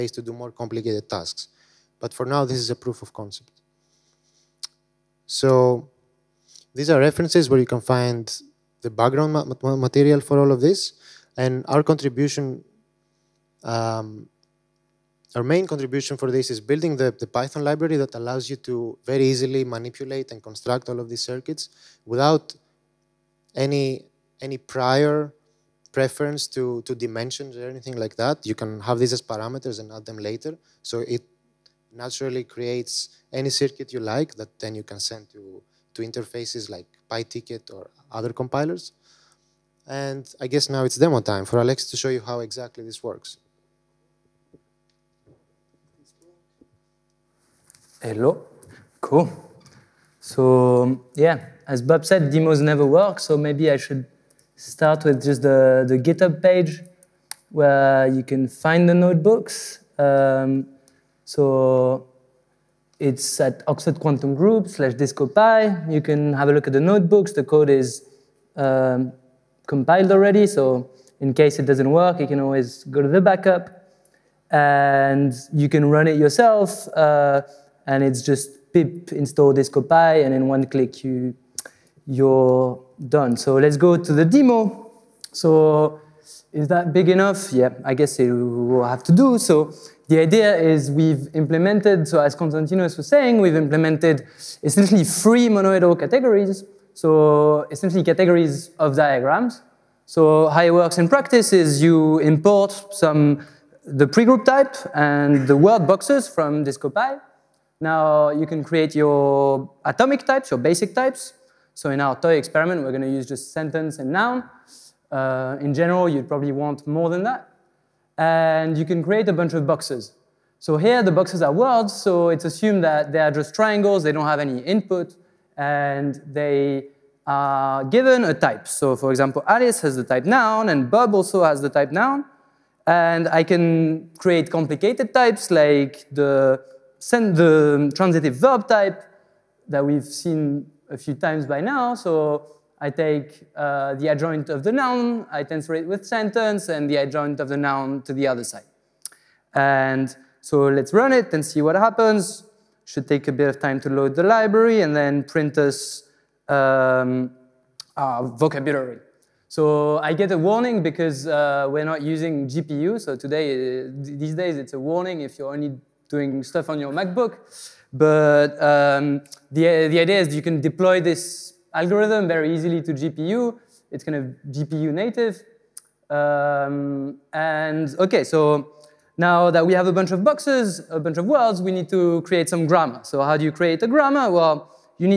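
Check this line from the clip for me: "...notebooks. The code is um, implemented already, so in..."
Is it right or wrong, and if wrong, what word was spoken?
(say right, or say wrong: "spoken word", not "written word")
wrong: "compiled", not "implemented".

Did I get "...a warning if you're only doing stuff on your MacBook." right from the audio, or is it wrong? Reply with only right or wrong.
right.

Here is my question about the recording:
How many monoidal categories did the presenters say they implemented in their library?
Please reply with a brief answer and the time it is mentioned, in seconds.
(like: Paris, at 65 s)
3, at 95 s.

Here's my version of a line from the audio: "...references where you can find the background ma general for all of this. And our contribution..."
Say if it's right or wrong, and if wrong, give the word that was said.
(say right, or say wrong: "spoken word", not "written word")
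wrong: "material", not "general".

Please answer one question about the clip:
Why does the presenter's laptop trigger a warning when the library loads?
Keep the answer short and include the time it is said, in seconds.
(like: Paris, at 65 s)
not using GPU, at 161 s.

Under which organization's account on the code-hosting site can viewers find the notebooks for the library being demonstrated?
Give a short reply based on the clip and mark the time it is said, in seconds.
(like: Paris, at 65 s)
Oxford Quantum Group, at 63 s.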